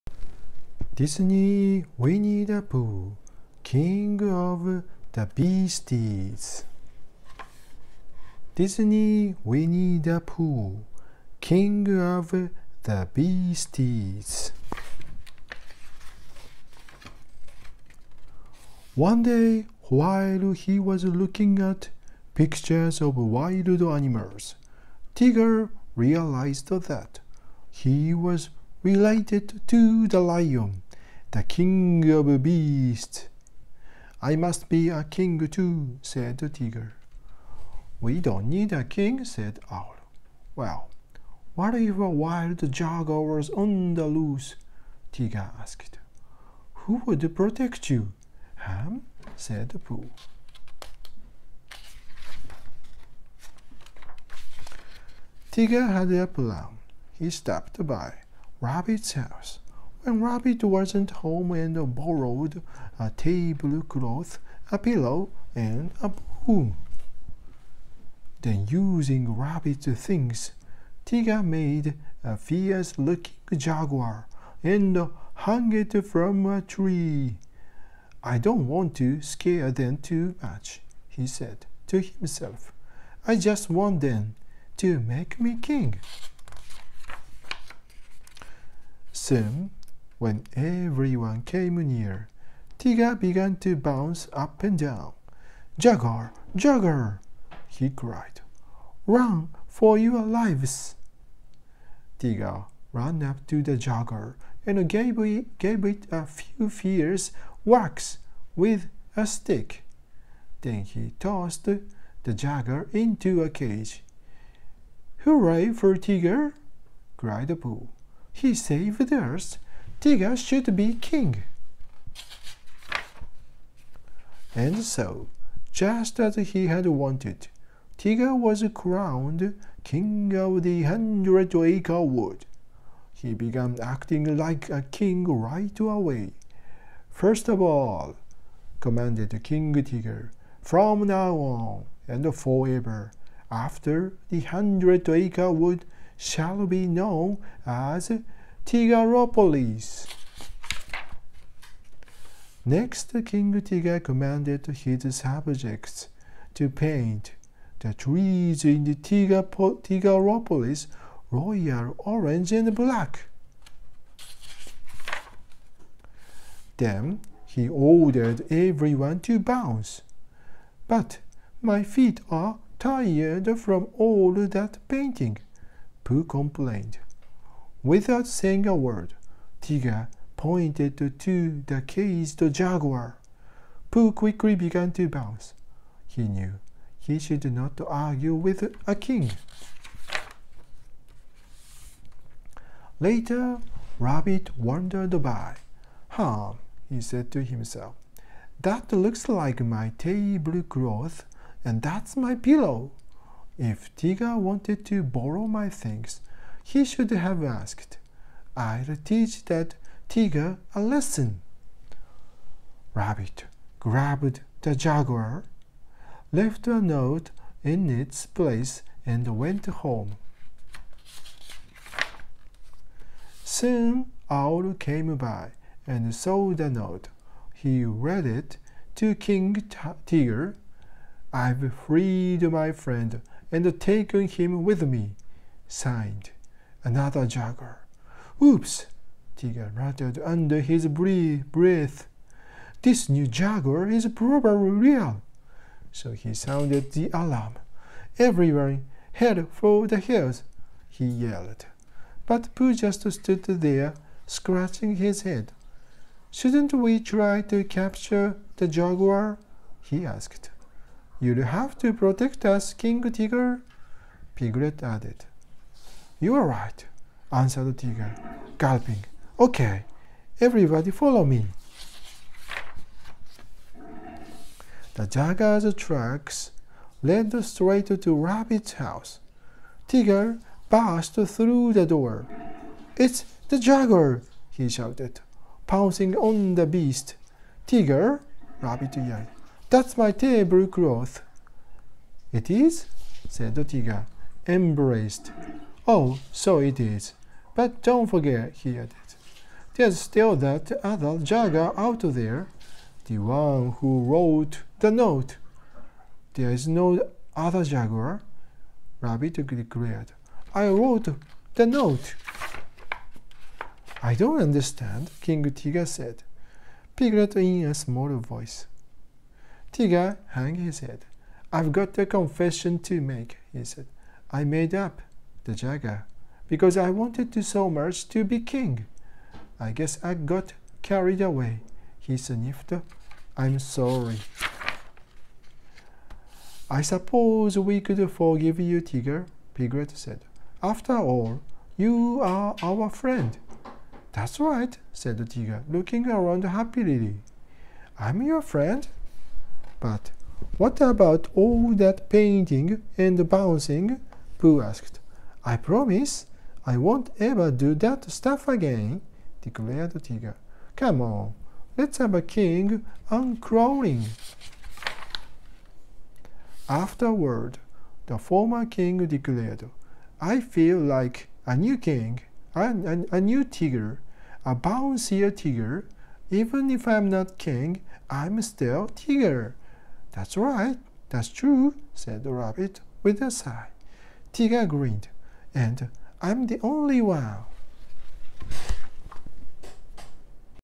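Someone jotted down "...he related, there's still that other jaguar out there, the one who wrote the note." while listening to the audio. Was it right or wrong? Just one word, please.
wrong.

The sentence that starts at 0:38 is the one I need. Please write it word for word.
We don't need a king, said Owl.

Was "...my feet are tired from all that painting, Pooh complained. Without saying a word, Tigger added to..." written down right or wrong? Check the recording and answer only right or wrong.
wrong.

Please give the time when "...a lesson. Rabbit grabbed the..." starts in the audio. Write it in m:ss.
3:30.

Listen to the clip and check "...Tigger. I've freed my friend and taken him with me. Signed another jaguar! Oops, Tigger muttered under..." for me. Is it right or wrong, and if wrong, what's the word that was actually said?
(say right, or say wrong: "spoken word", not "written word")
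right.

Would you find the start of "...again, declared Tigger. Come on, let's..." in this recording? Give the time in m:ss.
5:58.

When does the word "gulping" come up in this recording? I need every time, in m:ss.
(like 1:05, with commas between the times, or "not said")
4:28.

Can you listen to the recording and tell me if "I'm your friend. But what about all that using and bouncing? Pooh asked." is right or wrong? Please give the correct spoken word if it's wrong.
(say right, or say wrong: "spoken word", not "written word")
wrong: "painting", not "using".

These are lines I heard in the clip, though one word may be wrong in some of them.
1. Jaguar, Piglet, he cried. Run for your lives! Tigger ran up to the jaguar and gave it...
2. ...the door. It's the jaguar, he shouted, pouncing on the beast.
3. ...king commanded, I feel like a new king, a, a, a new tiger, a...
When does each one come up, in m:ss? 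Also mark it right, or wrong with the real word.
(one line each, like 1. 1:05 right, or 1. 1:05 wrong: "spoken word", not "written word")
1. 1:35 wrong: "Jaguar", not "Piglet"
2. 4:41 right
3. 6:08 wrong: "declared", not "commanded".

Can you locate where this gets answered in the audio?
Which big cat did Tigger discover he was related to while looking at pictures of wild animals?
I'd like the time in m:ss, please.
0:30.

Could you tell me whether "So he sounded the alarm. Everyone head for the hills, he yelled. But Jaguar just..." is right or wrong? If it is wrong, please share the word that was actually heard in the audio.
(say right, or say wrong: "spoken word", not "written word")
wrong: "Pooh", not "Jaguar".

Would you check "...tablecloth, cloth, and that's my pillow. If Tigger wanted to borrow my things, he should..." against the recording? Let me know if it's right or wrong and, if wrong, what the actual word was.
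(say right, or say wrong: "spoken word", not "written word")
right.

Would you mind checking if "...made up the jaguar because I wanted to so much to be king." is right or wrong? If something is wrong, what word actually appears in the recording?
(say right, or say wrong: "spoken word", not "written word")
right.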